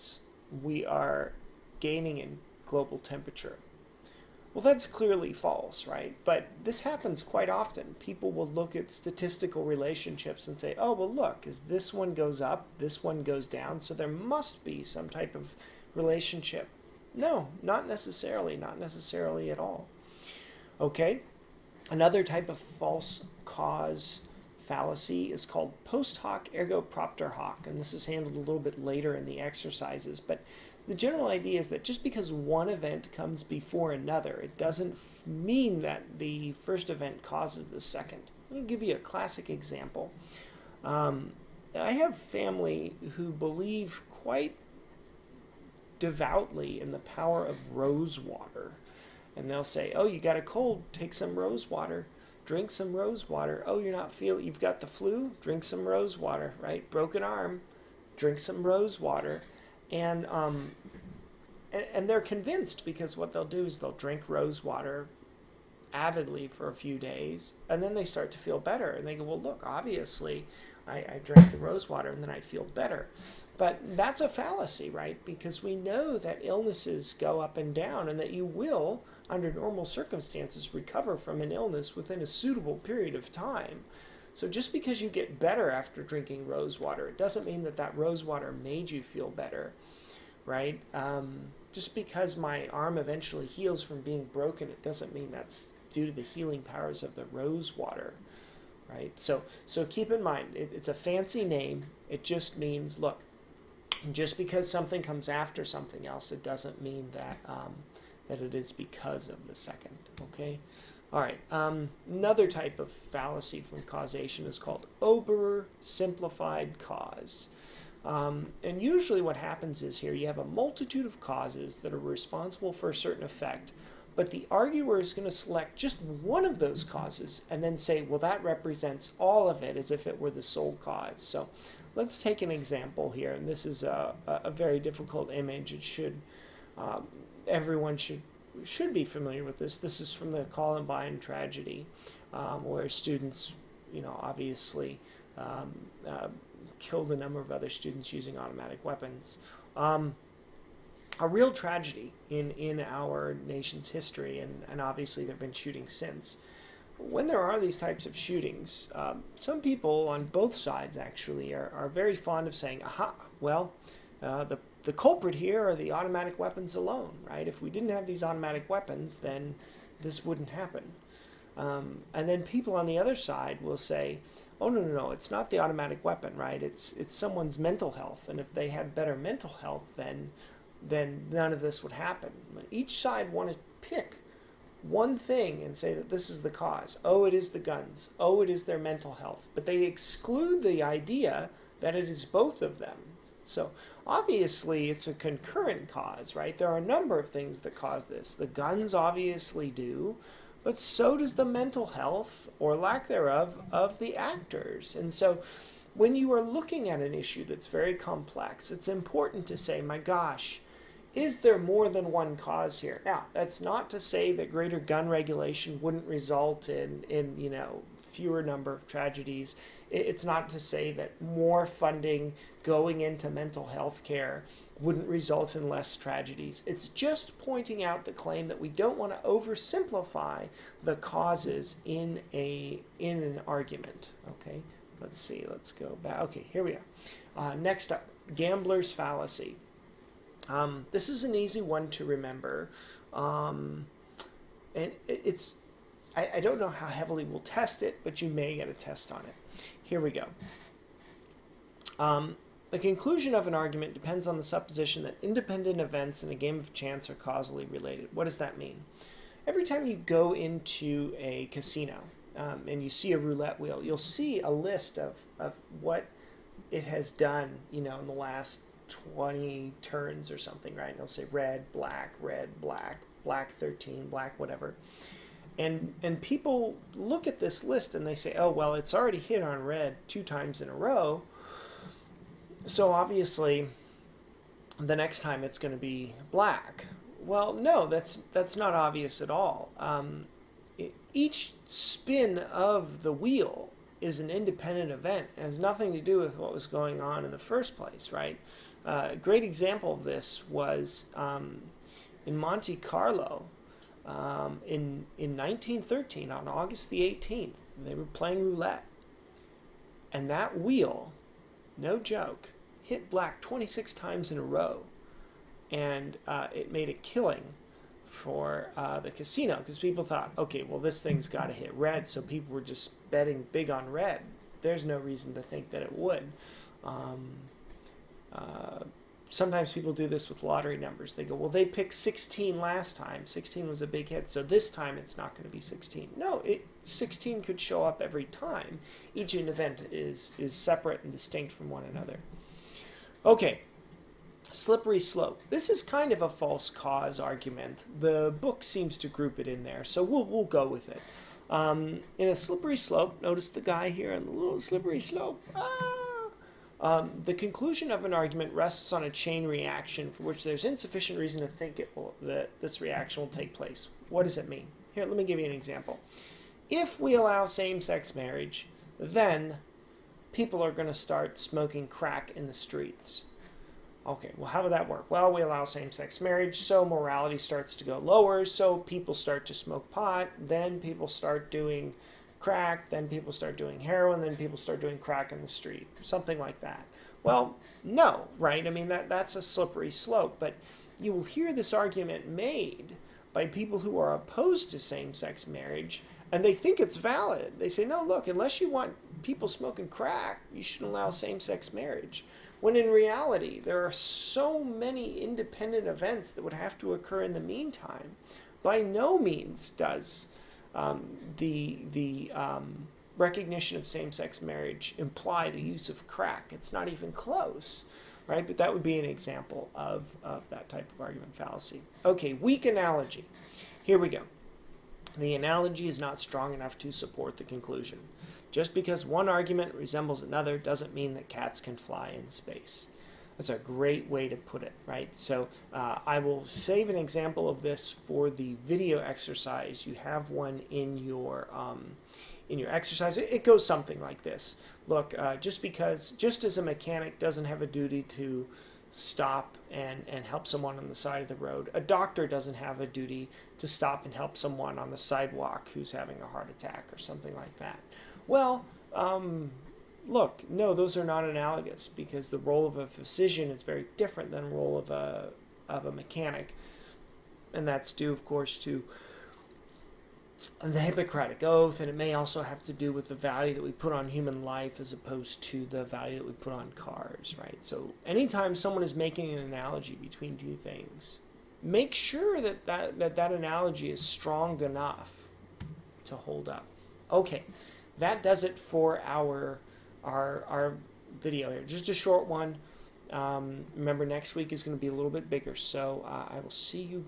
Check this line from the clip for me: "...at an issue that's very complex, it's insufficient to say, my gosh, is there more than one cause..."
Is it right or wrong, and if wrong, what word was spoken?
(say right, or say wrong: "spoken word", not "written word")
wrong: "important", not "insufficient".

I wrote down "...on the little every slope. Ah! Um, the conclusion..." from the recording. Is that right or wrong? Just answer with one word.
wrong.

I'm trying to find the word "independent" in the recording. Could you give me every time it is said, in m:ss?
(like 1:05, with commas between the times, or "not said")
4:15, 4:54, 6:45.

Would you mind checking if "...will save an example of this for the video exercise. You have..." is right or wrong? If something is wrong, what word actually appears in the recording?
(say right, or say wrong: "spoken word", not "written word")
right.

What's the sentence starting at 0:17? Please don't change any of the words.
No, not necessarily, not necessarily at all.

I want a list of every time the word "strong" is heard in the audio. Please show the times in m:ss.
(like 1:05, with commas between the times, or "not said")
7:06, 8:03.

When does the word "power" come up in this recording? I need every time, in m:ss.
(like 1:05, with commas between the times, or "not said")
0:46, 1:36.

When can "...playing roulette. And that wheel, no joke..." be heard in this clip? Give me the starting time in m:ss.
5:08.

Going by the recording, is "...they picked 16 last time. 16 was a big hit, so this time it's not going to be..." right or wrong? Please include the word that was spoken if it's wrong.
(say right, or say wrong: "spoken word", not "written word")
right.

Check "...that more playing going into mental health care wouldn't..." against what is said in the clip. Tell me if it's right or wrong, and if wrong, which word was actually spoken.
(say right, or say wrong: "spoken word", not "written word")
wrong: "funding", not "playing".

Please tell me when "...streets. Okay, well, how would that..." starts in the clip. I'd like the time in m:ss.
6:12.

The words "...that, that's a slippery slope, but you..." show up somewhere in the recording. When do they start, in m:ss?
6:28.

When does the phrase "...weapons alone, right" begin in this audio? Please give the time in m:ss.
2:46.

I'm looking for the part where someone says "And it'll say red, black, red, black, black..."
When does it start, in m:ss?
4:30.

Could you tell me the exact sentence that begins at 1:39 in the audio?
So, so keep in mind, it, it's a fancy name.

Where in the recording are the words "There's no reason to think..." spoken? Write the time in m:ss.
5:24.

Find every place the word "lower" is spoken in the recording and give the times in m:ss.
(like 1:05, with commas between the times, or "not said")
6:17.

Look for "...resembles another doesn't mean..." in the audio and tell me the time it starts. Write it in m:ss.
7:09.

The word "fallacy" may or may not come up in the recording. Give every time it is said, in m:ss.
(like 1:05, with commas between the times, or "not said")
0:24, 1:14, 1:52, 3:58, 7:01.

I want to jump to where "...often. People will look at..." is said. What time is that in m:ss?
0:07.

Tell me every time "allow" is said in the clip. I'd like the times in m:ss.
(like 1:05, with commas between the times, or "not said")
6:07, 6:15, 6:40.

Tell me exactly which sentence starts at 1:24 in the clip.
So just because you get better after drinking rose water, it doesn't mean that that rose water made you feel better, right?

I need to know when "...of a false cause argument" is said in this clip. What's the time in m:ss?
5:46.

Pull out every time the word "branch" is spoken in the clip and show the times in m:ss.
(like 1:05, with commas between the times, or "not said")
not said.